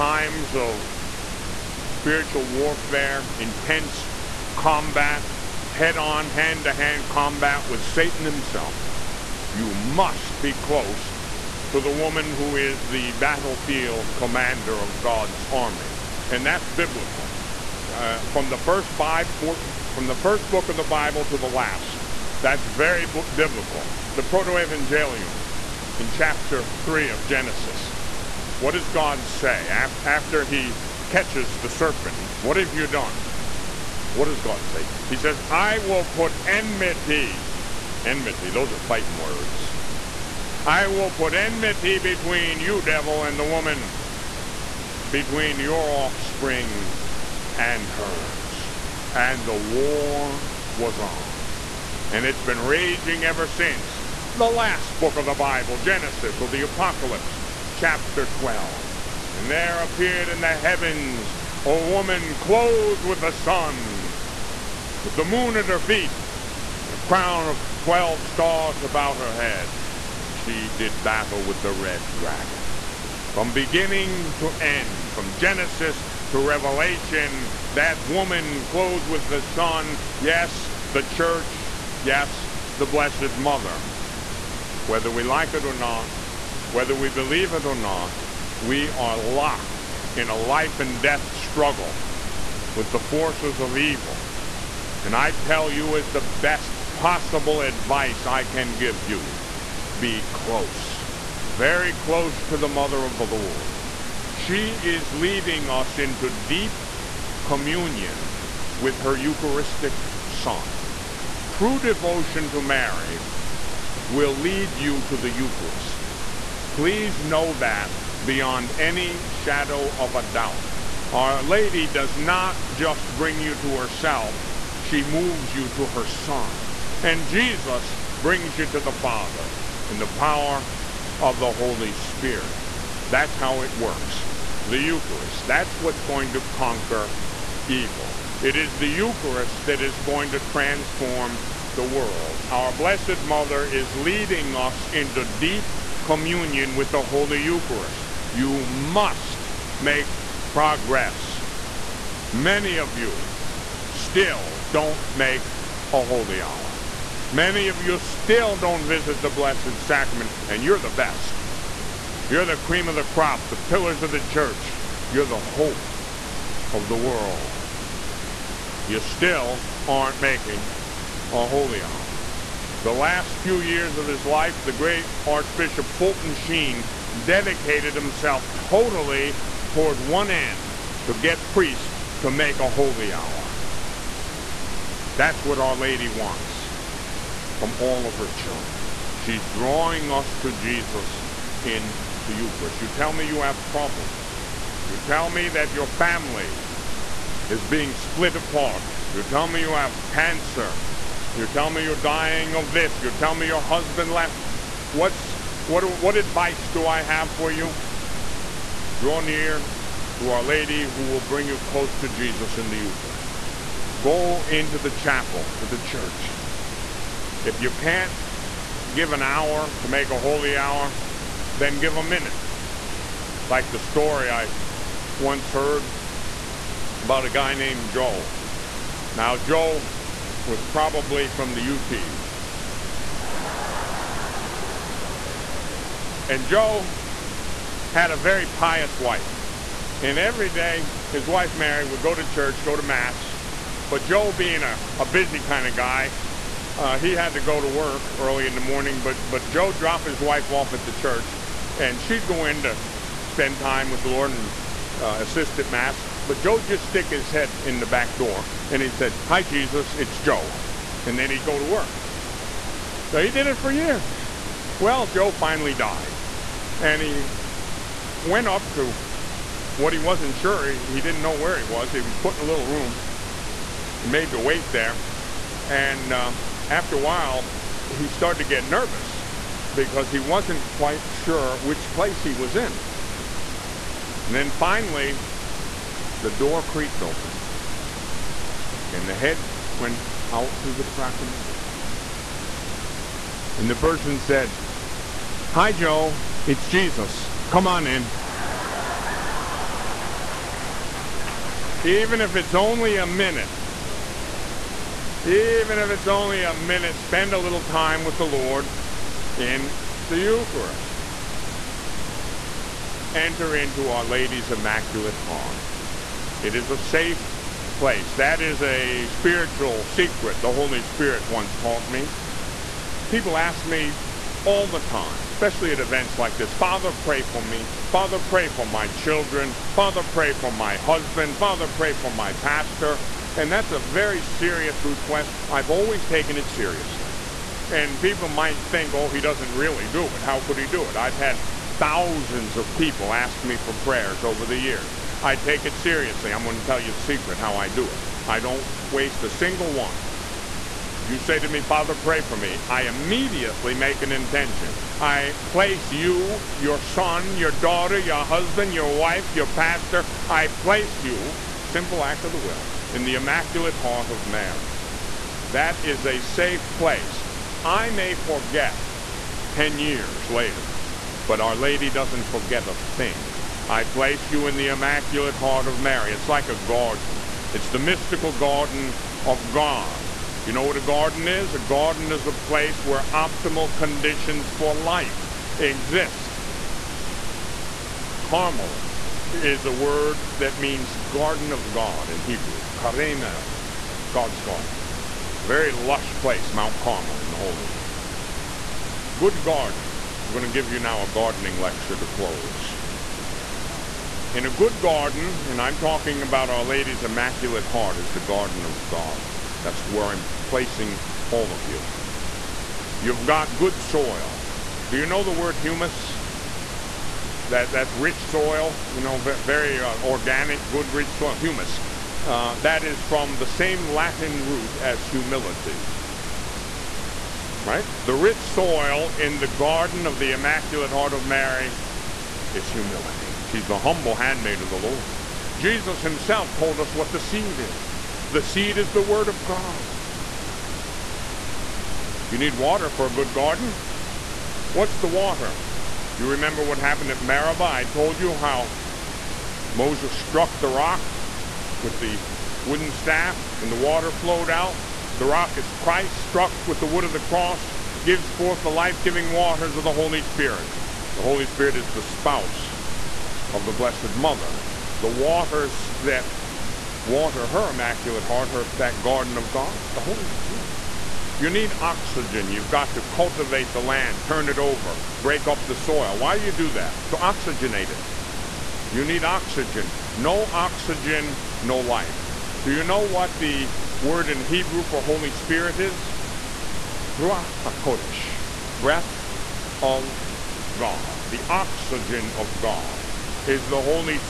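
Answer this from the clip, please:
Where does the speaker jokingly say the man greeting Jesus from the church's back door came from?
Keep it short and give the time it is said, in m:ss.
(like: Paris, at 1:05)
the UP, at 3:51.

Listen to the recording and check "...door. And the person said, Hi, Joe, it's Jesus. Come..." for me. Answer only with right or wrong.
right.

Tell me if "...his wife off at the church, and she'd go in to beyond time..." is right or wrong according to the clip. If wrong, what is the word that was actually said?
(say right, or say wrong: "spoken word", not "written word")
wrong: "spend", not "beyond".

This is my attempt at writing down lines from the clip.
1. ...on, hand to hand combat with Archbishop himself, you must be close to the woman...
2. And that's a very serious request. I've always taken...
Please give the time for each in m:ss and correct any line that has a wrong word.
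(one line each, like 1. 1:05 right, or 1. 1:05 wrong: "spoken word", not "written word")
1. 0:05 wrong: "Satan", not "Archbishop"
2. 5:33 right.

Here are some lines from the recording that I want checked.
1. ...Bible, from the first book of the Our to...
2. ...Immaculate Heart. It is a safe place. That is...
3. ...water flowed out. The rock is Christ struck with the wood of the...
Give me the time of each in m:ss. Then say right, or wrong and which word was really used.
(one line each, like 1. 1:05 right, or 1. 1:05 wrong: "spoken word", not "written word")
1. 0:18 wrong: "Bible", not "Our"
2. 5:14 right
3. 7:33 right.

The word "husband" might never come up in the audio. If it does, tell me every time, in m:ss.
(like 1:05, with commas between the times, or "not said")
3:23, 5:30, 5:58.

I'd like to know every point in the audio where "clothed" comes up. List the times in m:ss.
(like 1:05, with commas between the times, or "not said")
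1:02, 1:18.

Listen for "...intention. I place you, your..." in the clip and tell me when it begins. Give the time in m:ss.
5:54.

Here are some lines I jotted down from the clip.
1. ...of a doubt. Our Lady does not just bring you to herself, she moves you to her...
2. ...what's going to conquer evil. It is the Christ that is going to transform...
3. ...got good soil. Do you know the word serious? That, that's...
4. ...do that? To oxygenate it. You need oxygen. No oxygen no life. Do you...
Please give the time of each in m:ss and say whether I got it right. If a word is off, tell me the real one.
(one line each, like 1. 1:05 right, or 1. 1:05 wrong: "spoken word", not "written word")
1. 1:59 right
2. 2:15 wrong: "Eucharist", not "Christ"
3. 6:53 wrong: "humus", not "serious"
4. 7:56 right.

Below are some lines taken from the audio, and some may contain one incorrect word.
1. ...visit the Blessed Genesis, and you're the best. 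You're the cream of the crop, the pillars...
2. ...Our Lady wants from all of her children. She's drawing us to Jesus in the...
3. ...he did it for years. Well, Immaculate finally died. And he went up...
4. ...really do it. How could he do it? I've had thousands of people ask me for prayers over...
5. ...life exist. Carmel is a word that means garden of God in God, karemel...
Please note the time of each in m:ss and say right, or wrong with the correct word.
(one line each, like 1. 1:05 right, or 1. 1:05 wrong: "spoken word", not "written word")
1. 2:38 wrong: "Sacrament", not "Genesis"
2. 3:05 right
3. 4:23 wrong: "Joe", not "Immaculate"
4. 5:39 right
5. 6:24 wrong: "Hebrew", not "God".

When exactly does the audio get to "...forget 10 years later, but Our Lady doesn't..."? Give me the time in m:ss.
6:08.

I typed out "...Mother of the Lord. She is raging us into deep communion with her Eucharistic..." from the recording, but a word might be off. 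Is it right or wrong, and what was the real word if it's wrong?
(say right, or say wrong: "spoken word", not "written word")
wrong: "leading", not "raging".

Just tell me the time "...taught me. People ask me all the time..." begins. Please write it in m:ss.
5:21.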